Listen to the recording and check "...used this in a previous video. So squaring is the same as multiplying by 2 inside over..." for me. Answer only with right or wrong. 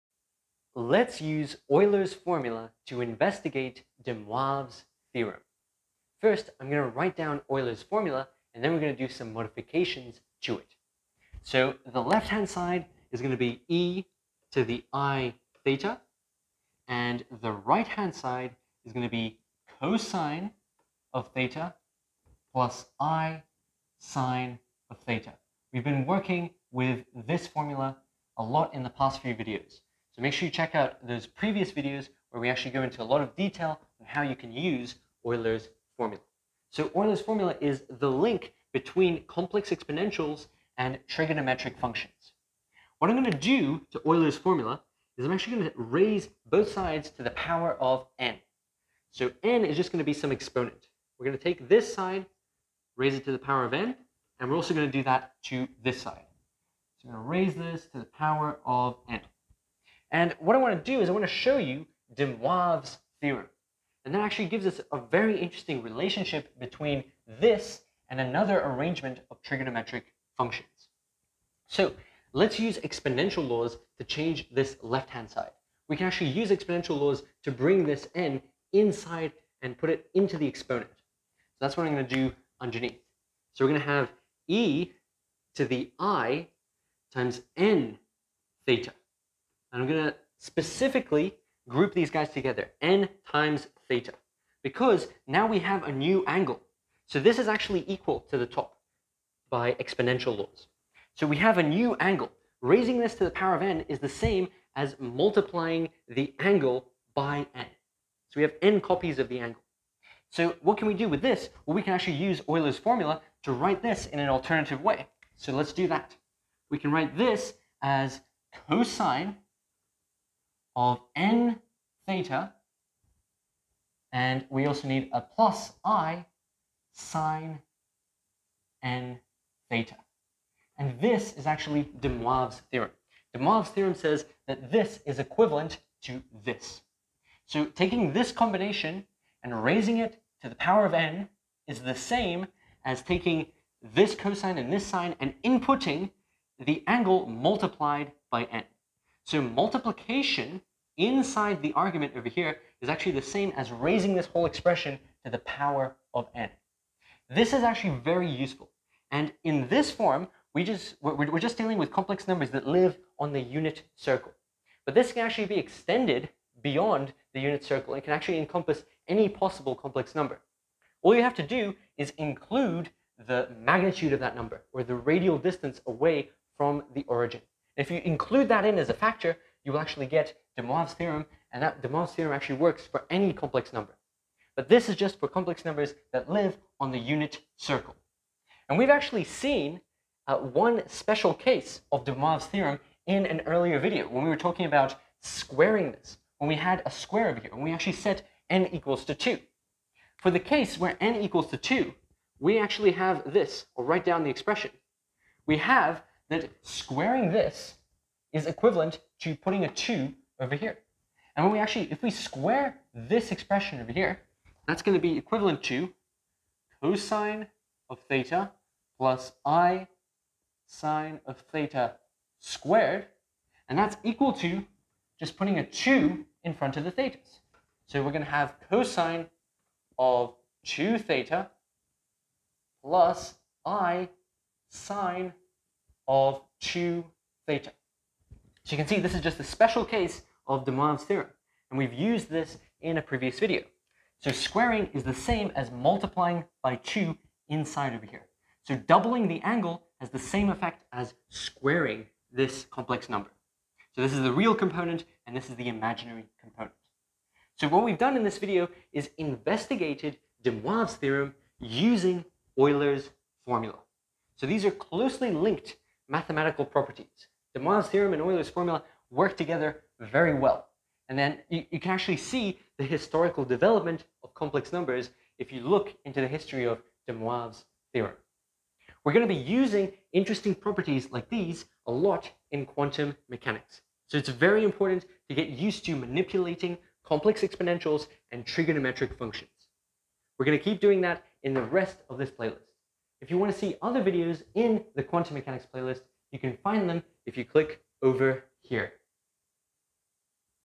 right.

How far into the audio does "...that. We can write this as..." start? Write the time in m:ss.
1:55.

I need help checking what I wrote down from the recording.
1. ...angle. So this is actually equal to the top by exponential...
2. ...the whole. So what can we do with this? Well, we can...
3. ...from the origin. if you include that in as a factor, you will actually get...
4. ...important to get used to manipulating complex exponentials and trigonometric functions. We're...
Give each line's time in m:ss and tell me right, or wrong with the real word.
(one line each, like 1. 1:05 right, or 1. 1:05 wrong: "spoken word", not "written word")
1. 1:36 right
2. 1:49 wrong: "angle", not "whole"
3. 2:56 right
4. 4:44 right.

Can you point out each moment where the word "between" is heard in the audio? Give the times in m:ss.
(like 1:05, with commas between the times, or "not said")
0:38, 1:06.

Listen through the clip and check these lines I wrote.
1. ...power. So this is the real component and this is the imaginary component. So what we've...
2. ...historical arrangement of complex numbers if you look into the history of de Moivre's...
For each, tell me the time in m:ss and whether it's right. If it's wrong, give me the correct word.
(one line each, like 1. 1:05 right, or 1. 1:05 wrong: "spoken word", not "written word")
1. 4:13 wrong: "number", not "power"
2. 4:32 wrong: "development", not "arrangement".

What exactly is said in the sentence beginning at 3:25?
We have that squaring this is equivalent to putting a 2 over here.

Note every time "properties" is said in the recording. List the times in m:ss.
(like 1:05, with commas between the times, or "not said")
4:26, 4:40.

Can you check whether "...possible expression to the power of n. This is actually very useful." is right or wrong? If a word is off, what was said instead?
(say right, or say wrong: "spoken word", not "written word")
wrong: "whole", not "possible".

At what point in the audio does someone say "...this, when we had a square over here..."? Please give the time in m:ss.
3:15.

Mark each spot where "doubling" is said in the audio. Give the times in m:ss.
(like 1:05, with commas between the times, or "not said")
4:08.